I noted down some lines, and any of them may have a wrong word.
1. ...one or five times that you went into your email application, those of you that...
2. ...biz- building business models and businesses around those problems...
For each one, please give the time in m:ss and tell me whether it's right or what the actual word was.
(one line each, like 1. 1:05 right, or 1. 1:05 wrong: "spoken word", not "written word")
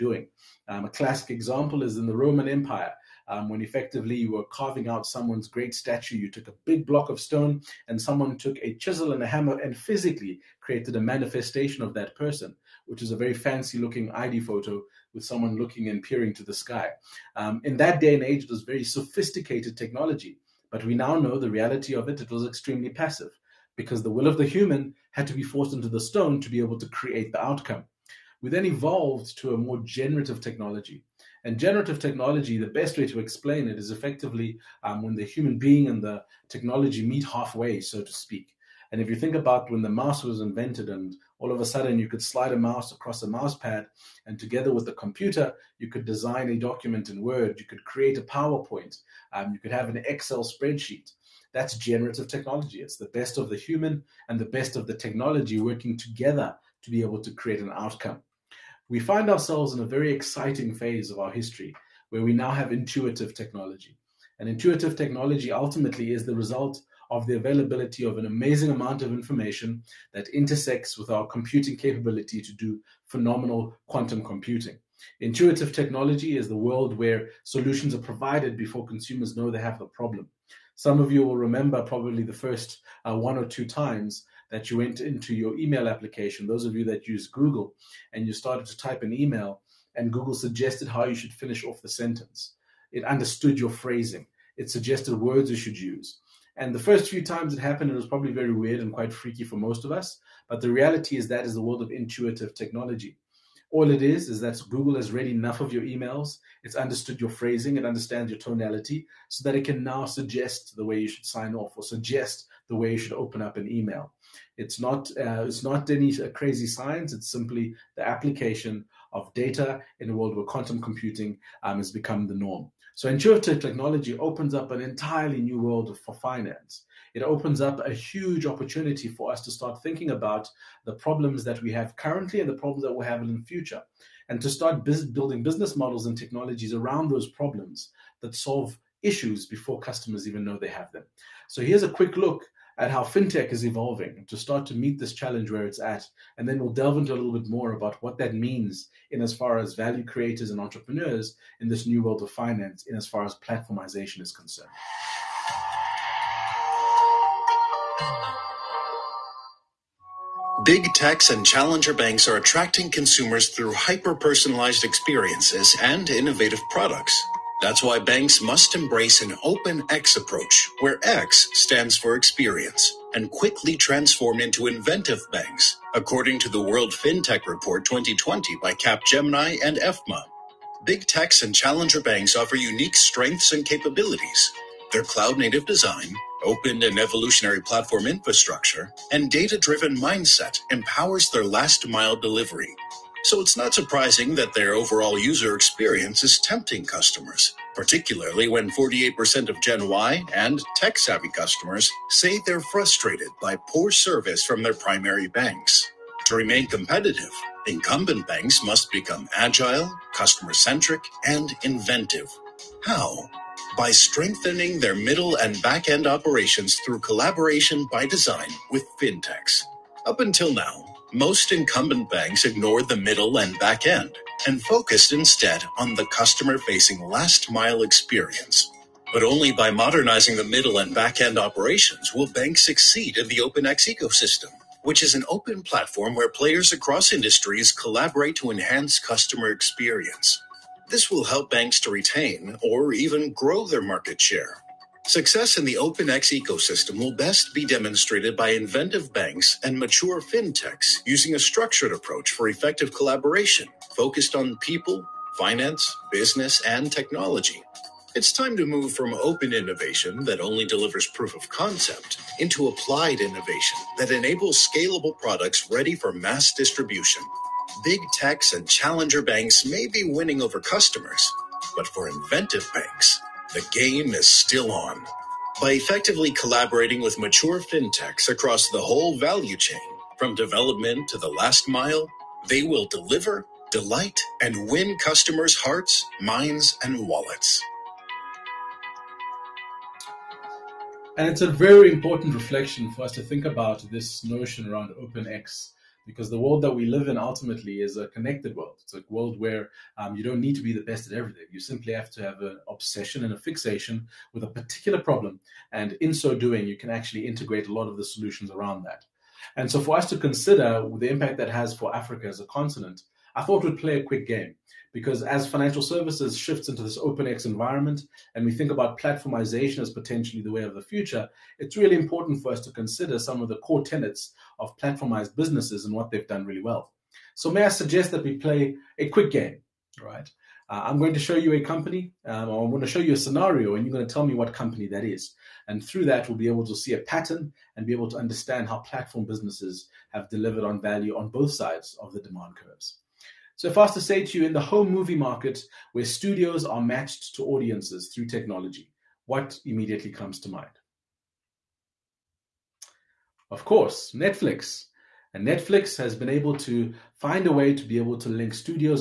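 1. 1:23 wrong: "two", not "five"
2. 2:14 wrong: "technologies", not "businesses".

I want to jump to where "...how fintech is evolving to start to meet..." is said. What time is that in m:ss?
2:22.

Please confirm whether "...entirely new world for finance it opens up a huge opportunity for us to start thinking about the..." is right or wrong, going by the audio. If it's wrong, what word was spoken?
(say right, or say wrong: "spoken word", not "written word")
right.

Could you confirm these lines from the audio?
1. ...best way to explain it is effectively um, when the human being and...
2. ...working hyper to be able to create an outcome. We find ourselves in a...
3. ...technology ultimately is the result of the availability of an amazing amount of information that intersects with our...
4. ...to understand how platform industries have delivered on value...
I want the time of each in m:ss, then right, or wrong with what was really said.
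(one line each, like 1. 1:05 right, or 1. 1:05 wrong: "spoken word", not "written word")
1. 0:32 right
2. 0:55 wrong: "together", not "hyper"
3. 1:04 right
4. 5:38 wrong: "businesses", not "industries".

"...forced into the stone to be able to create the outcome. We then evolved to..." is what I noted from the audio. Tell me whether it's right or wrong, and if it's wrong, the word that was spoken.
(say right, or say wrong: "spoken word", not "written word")
right.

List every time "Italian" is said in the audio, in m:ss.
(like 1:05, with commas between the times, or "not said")
not said.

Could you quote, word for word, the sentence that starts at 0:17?
Um, in that day and age, it was very sophisticated technology, but we now know the reality of it.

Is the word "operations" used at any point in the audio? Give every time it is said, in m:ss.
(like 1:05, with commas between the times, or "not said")
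3:36, 3:51.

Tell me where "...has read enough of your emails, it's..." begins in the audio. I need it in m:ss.
1:44.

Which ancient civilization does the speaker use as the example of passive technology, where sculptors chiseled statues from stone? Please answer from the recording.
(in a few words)
Roman Empire.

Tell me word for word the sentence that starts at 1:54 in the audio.
It's not uh, it's not any uh, crazy science.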